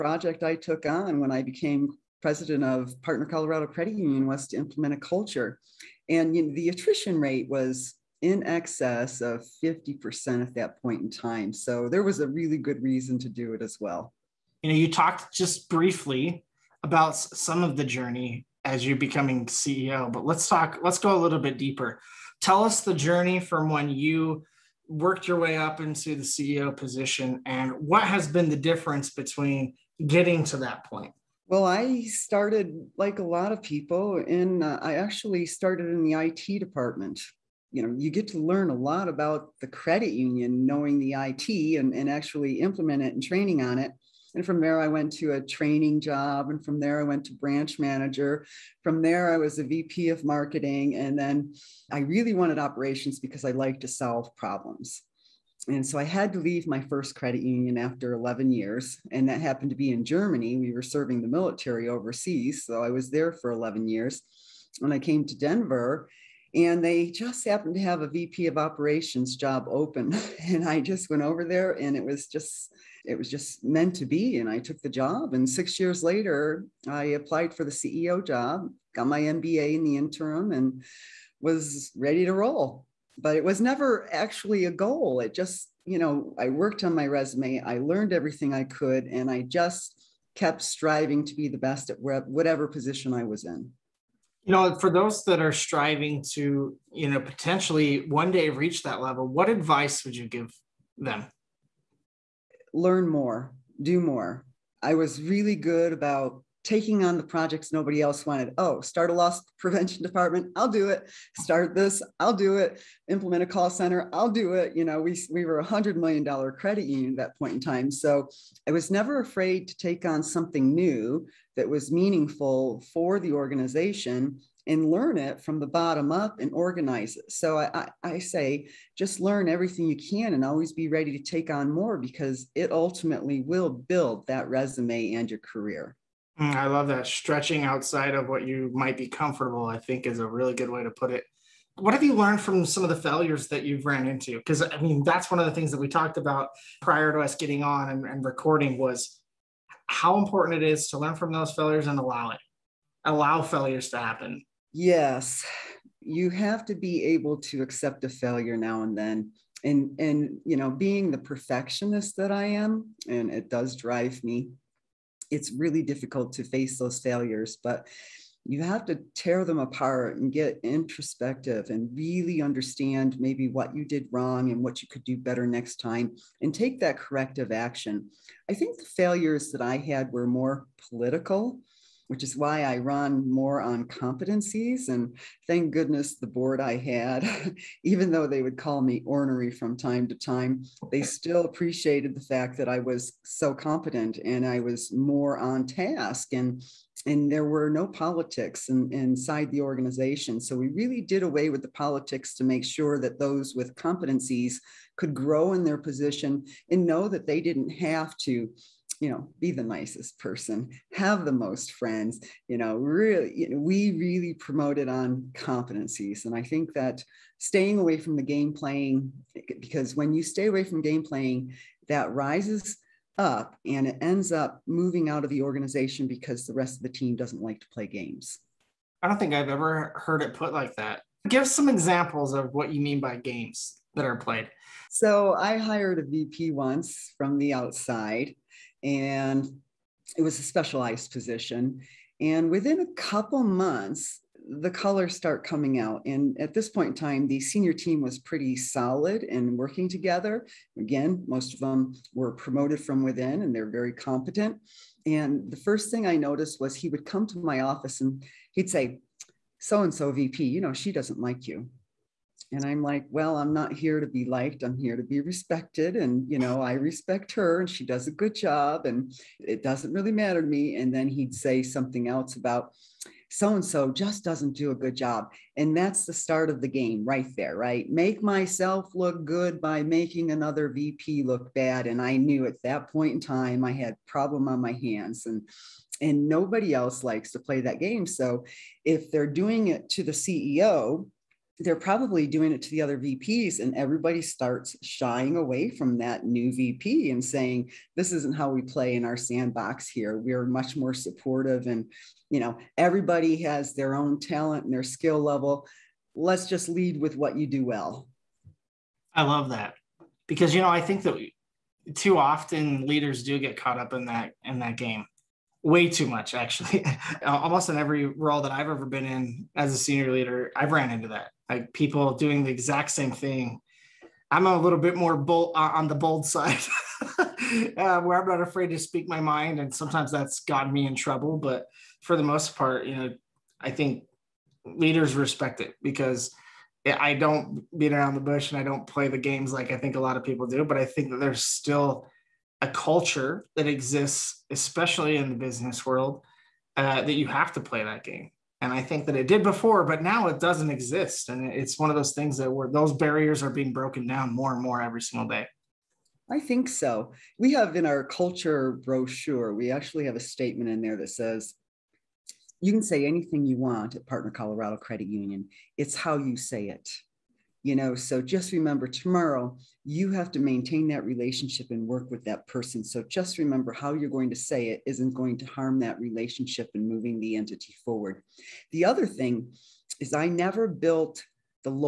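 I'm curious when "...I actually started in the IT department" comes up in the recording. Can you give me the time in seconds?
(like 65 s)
34 s.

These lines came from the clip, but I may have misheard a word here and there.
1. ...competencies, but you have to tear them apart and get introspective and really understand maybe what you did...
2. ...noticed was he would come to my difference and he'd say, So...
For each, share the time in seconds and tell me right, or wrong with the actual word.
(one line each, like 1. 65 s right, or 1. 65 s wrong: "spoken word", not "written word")
1. 166 s wrong: "failures", not "competencies"
2. 256 s wrong: "office", not "difference".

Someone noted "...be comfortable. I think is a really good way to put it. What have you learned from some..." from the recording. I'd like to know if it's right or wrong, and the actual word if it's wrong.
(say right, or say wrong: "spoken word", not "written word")
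right.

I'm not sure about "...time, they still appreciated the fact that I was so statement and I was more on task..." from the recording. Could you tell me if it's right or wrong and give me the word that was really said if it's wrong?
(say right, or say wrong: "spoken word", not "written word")
wrong: "competent", not "statement".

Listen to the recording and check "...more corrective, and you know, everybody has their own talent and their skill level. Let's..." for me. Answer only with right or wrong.
wrong.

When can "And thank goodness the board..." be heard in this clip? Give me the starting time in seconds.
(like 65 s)
184 s.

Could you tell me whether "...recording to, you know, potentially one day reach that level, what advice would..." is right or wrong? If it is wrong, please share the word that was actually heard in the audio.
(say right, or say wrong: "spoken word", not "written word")
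wrong: "striving", not "recording".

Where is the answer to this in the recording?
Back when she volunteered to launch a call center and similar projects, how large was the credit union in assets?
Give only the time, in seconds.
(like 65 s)
115 s.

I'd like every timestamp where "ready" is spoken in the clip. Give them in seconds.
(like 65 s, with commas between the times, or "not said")
81 s, 130 s.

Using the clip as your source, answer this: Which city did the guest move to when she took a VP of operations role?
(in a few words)
Denver.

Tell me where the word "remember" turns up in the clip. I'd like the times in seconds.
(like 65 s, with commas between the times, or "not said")
368 s, 373 s.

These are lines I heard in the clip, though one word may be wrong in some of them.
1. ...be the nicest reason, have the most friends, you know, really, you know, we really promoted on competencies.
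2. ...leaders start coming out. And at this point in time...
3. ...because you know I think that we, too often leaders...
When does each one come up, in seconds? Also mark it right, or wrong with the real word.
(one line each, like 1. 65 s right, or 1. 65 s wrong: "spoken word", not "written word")
1. 209 s wrong: "person", not "reason"
2. 244 s wrong: "colors", not "leaders"
3. 310 s right.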